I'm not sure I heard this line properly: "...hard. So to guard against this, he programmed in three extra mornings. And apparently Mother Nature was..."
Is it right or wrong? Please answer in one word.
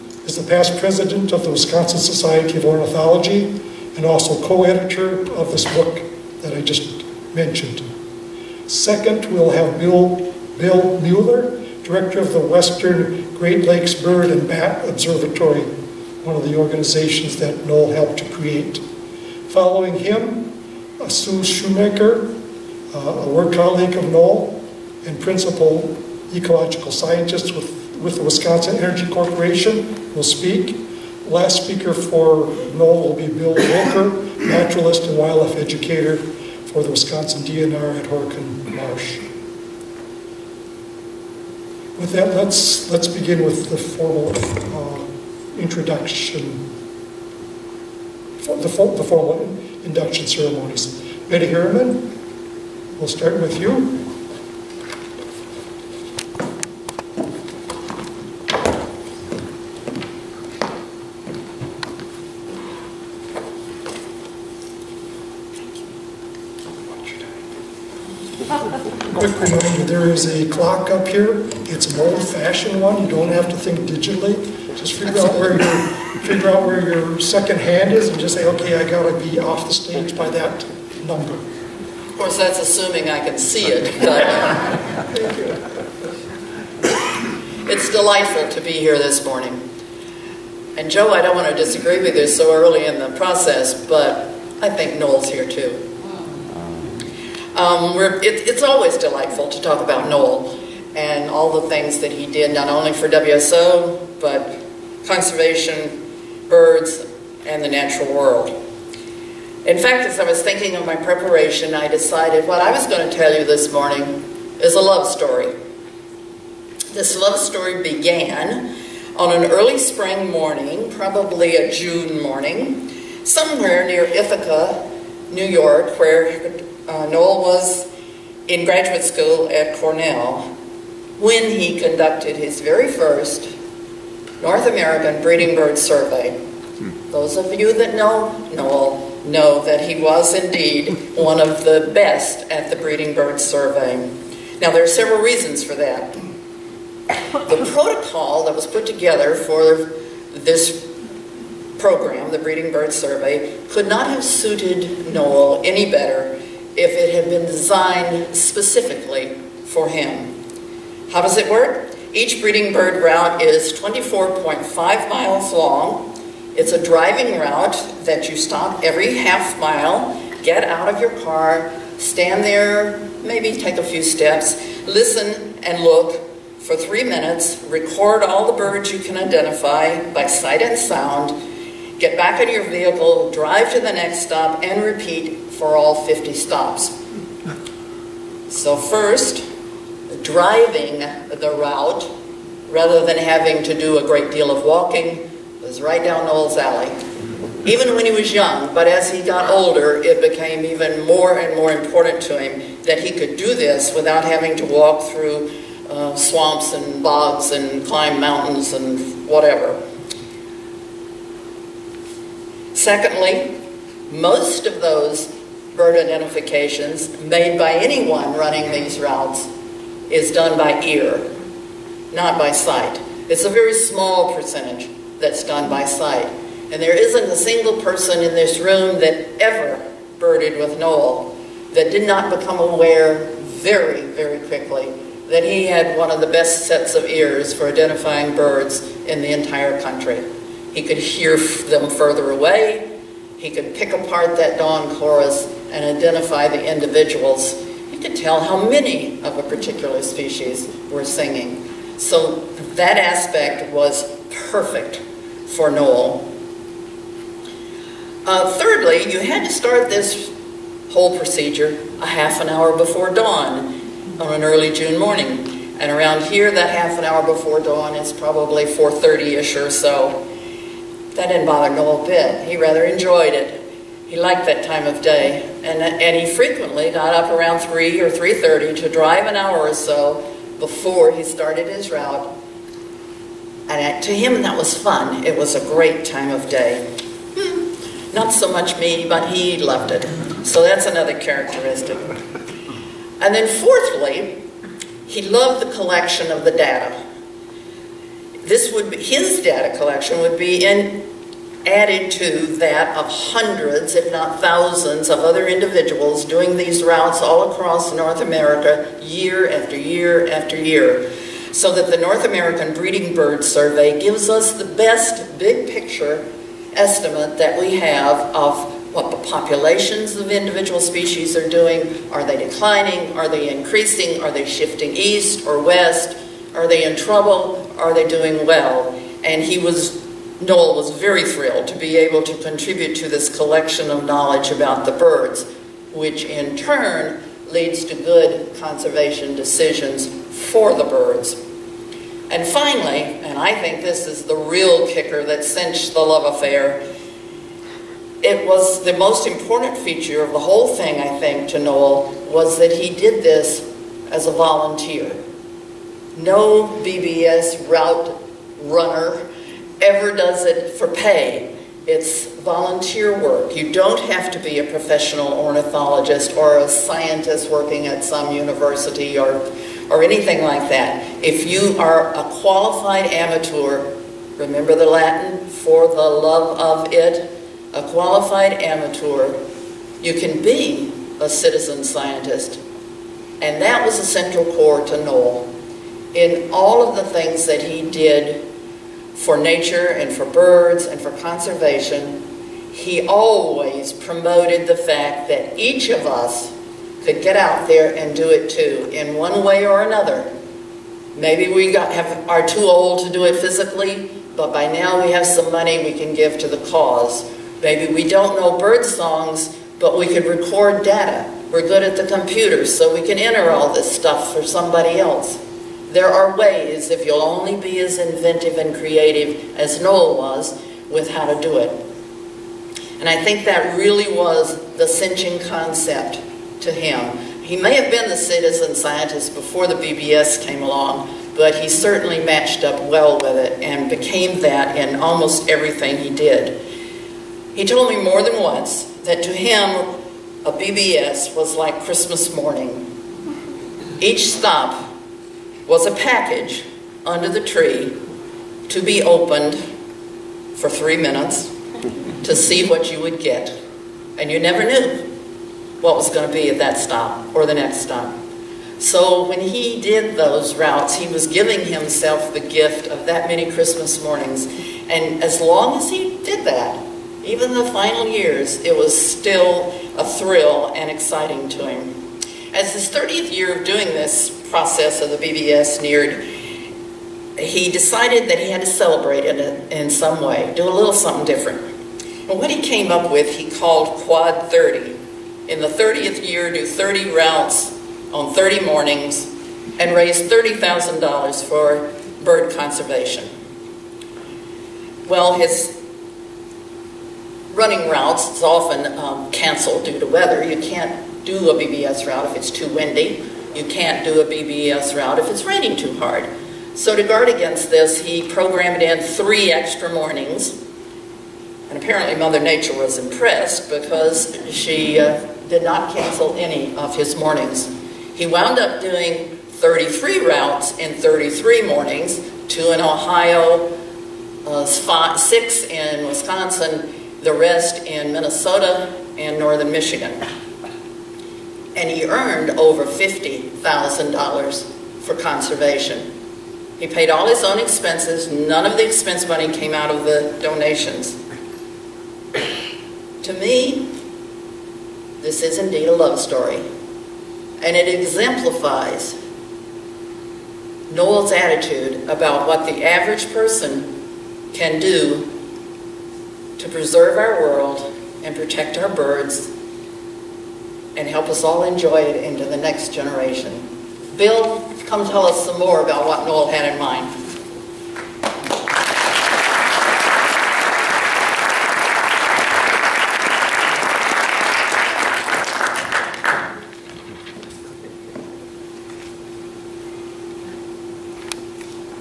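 right.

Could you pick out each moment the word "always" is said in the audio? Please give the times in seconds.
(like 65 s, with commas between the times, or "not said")
98 s, 393 s.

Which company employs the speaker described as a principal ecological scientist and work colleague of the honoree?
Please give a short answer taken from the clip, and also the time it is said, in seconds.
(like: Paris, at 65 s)
Wisconsin Energy Corporation, at 28 s.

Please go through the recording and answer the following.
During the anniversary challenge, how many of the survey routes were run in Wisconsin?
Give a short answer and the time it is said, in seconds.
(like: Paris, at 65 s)
6, at 525 s.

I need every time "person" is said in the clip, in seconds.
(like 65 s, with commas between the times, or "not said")
227 s, 553 s.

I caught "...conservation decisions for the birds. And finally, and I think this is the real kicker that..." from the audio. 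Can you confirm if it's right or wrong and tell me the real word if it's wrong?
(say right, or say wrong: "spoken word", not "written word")
right.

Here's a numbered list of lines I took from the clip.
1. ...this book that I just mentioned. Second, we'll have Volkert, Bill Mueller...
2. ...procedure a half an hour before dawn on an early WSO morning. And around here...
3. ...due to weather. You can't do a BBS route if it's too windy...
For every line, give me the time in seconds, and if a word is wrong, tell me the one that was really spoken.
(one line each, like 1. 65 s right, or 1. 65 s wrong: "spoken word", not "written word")
1. 5 s wrong: "Bill", not "Volkert"
2. 261 s wrong: "June", not "WSO"
3. 499 s right.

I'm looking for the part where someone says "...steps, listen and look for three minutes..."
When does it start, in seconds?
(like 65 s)
174 s.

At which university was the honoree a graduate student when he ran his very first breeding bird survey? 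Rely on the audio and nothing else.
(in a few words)
Cornell.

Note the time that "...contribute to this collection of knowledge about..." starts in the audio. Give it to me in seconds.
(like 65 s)
332 s.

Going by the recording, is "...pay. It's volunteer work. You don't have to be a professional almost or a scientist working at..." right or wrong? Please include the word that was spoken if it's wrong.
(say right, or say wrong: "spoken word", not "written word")
wrong: "ornithologist", not "almost".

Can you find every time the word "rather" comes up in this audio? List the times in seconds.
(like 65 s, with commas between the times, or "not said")
192 s, 272 s.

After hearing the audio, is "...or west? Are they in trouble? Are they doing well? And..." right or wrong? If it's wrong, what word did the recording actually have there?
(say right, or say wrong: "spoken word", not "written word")
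right.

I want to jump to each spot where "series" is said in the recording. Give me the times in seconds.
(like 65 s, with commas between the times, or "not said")
not said.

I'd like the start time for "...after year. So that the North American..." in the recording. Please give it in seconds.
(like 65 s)
310 s.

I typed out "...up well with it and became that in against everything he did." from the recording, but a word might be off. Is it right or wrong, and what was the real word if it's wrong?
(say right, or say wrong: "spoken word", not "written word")
wrong: "almost", not "against".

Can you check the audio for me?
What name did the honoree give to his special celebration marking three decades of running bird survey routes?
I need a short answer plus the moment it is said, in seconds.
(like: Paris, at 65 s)
Quad 30, at 484 s.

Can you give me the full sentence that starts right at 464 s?
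And as long as he did that, even the final years, it was still a thrill and exciting to him.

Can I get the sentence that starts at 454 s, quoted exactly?
And you never knew what was going to be at that stop or the next stop.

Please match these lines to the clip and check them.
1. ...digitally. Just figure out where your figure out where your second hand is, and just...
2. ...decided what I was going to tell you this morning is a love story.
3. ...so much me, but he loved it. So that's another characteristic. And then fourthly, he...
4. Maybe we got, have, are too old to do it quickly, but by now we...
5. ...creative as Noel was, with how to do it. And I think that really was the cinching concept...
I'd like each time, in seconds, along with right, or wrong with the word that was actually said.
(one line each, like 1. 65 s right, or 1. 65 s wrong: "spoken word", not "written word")
1. 73 s right
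2. 111 s right
3. 288 s right
4. 401 s wrong: "physically", not "quickly"
5. 418 s right.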